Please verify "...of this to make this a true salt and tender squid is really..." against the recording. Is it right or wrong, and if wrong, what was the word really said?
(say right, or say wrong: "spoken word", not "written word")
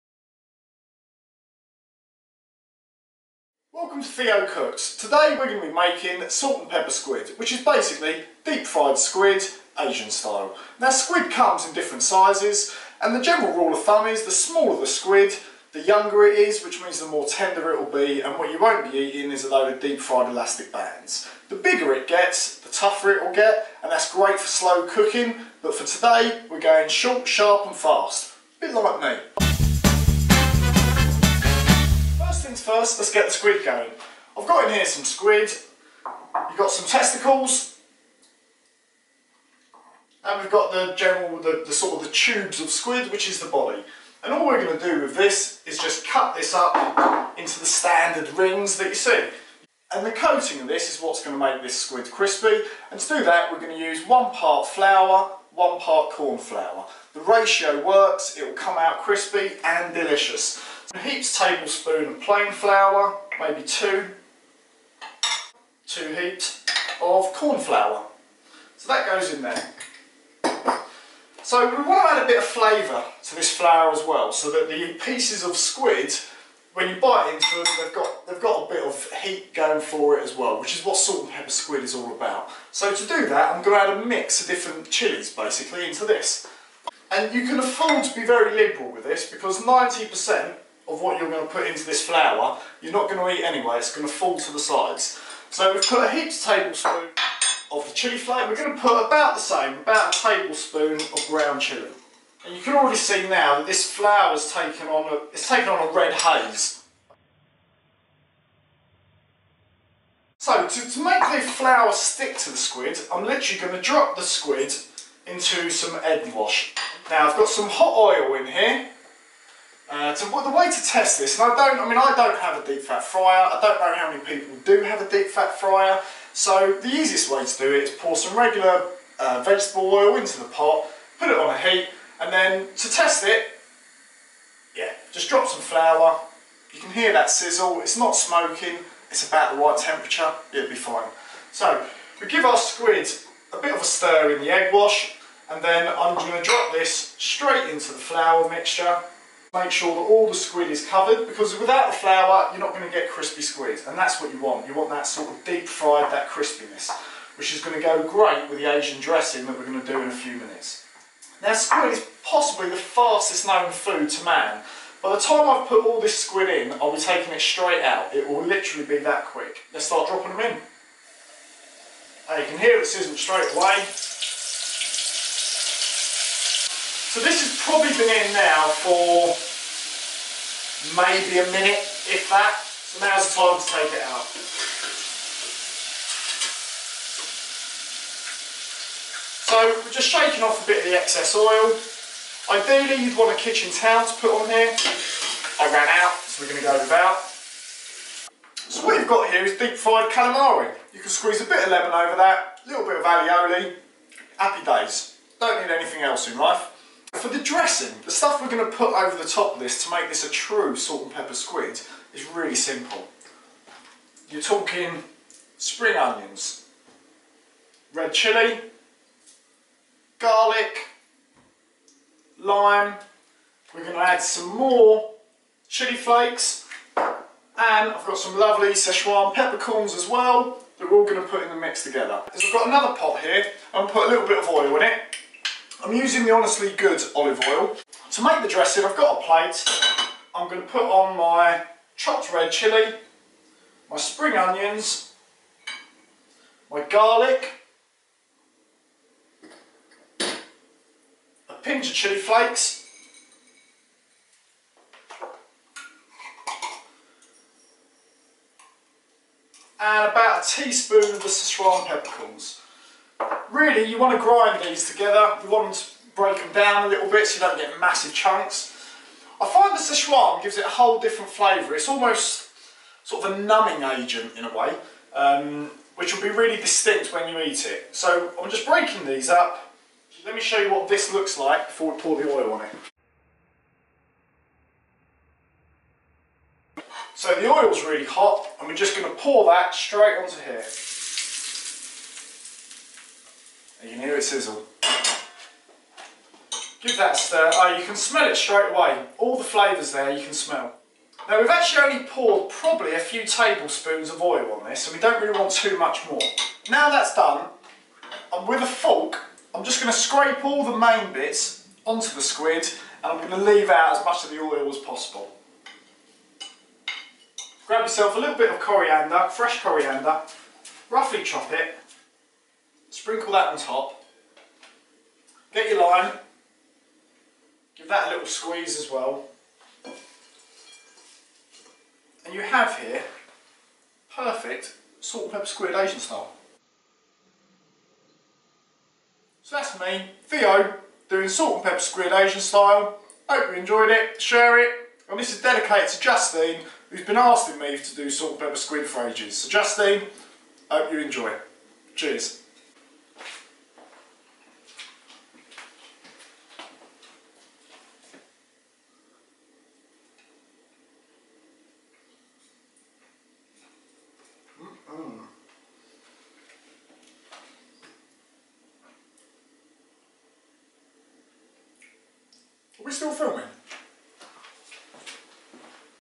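wrong: "pepper", not "tender".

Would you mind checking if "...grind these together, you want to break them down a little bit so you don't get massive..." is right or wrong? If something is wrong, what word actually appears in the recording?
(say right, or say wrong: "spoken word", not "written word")
right.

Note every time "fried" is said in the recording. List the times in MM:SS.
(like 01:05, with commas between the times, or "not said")
00:08, 00:20, 02:35, 03:19.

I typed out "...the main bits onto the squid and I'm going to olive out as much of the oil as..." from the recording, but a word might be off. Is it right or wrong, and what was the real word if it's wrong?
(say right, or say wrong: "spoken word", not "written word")
wrong: "leave", not "olive".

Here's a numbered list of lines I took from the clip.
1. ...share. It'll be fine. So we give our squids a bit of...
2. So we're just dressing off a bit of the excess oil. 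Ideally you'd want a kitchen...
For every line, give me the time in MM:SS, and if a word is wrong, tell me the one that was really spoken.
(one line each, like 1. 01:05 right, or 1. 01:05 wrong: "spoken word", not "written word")
1. 02:19 wrong: "temperature", not "share"
2. 03:09 wrong: "shaking", not "dressing".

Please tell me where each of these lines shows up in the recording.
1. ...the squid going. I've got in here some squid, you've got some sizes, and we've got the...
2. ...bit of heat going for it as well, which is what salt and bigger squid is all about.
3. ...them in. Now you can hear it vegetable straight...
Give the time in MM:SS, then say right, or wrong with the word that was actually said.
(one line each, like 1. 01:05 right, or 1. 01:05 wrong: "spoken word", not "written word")
1. 00:33 wrong: "testicles", not "sizes"
2. 01:18 wrong: "pepper", not "bigger"
3. 02:50 wrong: "sizzle", not "vegetable".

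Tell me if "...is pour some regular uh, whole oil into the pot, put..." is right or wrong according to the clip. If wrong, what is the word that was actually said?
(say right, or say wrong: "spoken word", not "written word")
wrong: "vegetable", not "whole".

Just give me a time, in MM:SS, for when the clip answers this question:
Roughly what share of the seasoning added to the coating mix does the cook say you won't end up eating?
01:29.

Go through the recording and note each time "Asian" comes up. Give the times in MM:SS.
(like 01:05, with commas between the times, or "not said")
00:09, 02:38, 05:35, 05:42.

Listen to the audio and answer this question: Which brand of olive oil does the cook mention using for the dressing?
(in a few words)
Honestly Good.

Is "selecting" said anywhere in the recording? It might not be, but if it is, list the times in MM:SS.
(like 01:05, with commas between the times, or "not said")
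not said.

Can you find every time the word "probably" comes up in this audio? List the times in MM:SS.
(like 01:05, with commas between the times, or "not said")
02:57, 05:02.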